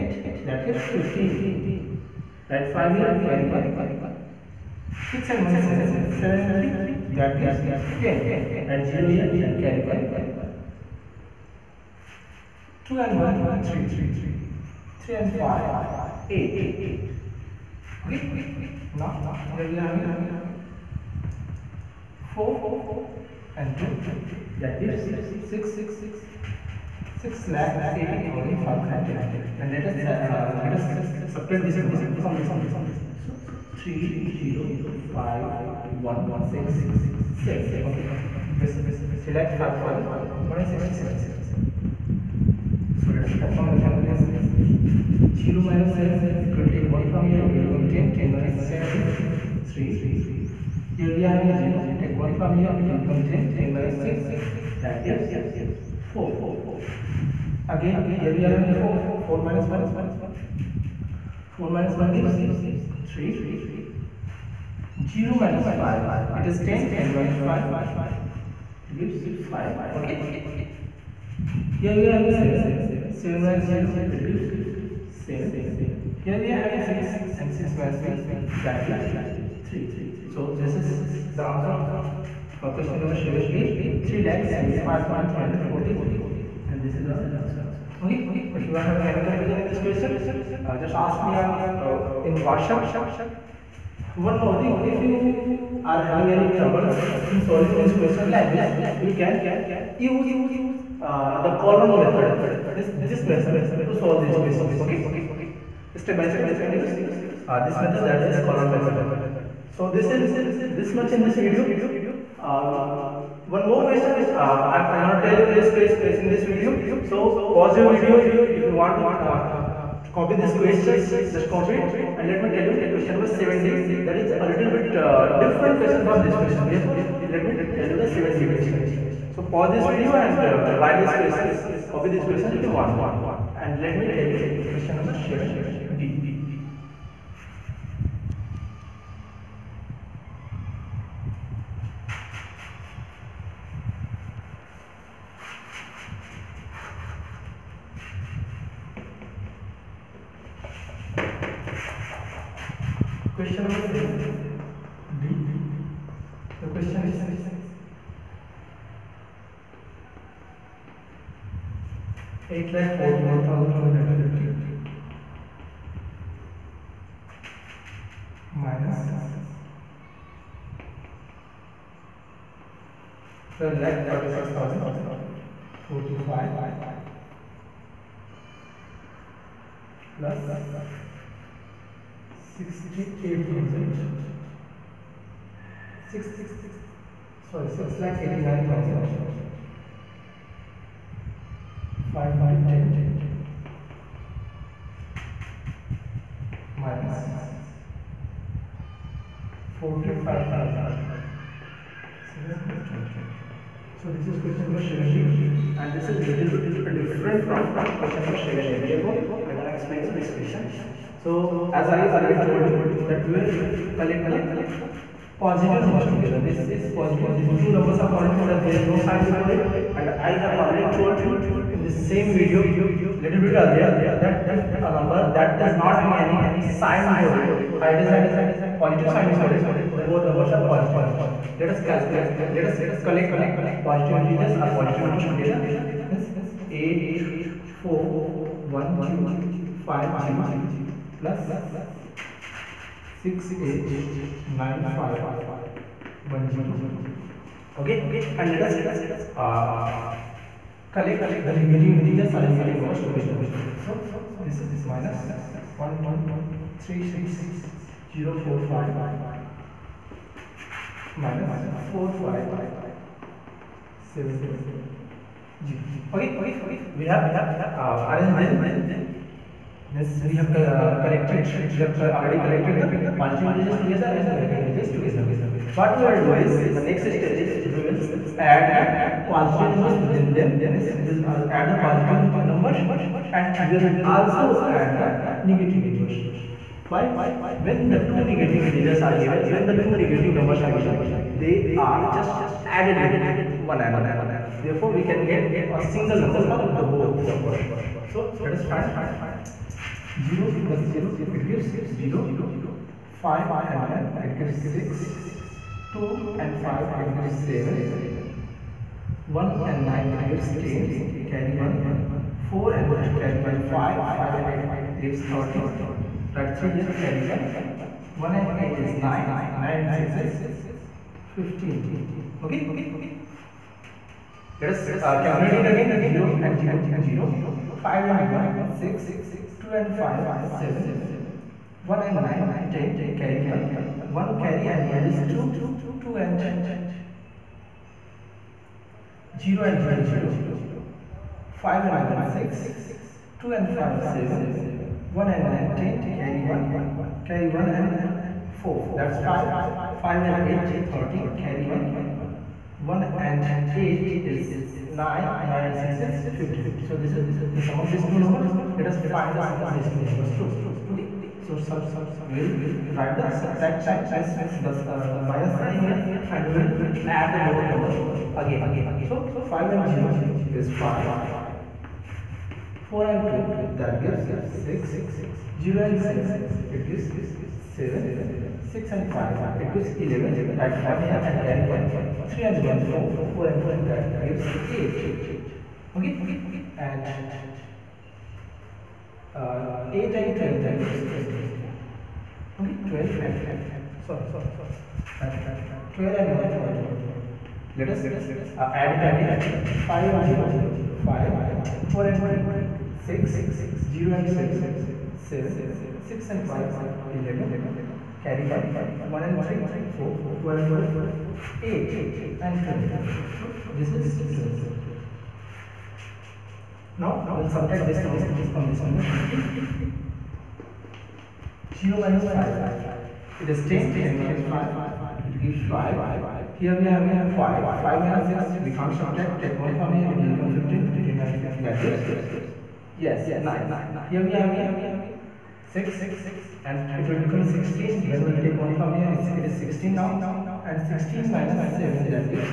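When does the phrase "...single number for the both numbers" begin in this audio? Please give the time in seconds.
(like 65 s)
295 s.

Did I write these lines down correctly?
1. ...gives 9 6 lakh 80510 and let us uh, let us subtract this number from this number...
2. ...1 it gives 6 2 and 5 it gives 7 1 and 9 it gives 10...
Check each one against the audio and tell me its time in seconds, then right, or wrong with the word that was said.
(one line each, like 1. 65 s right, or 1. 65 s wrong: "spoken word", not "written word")
1. 24 s wrong: "6", not "9"
2. 303 s right.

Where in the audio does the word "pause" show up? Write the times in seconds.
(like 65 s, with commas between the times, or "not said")
117 s, 129 s.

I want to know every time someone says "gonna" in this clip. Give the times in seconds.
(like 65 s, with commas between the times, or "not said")
115 s, 209 s.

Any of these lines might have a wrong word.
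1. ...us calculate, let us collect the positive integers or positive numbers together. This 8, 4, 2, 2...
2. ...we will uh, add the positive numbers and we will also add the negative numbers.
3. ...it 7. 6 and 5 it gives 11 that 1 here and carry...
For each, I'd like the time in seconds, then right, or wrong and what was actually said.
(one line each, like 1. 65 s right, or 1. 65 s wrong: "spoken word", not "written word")
1. 231 s wrong: "1", not "2"
2. 281 s right
3. 376 s right.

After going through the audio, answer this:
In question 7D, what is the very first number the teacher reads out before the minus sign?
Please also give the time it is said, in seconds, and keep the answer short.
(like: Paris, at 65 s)
8 lakh 41,250, at 162 s.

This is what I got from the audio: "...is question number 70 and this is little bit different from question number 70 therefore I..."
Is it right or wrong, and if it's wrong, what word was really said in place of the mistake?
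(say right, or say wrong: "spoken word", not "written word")
right.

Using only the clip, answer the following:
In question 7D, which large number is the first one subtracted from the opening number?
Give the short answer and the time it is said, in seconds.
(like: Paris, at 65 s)
12 lakh 36,045, at 173 s.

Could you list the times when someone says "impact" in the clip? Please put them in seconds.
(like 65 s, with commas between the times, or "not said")
not said.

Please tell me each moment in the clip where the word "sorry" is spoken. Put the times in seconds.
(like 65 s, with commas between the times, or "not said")
187 s, 394 s.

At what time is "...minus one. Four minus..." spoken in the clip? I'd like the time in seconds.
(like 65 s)
59 s.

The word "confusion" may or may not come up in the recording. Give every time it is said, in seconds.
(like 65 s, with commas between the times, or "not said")
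89 s.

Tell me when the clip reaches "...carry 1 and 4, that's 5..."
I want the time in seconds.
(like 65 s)
347 s.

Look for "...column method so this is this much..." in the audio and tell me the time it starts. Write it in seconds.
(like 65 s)
108 s.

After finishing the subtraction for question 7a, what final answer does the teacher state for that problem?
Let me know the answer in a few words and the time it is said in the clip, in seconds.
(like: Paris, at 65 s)
3 lakh 75,343, at 84 s.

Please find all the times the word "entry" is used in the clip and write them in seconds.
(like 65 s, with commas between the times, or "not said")
not said.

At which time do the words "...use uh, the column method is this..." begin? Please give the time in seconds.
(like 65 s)
99 s.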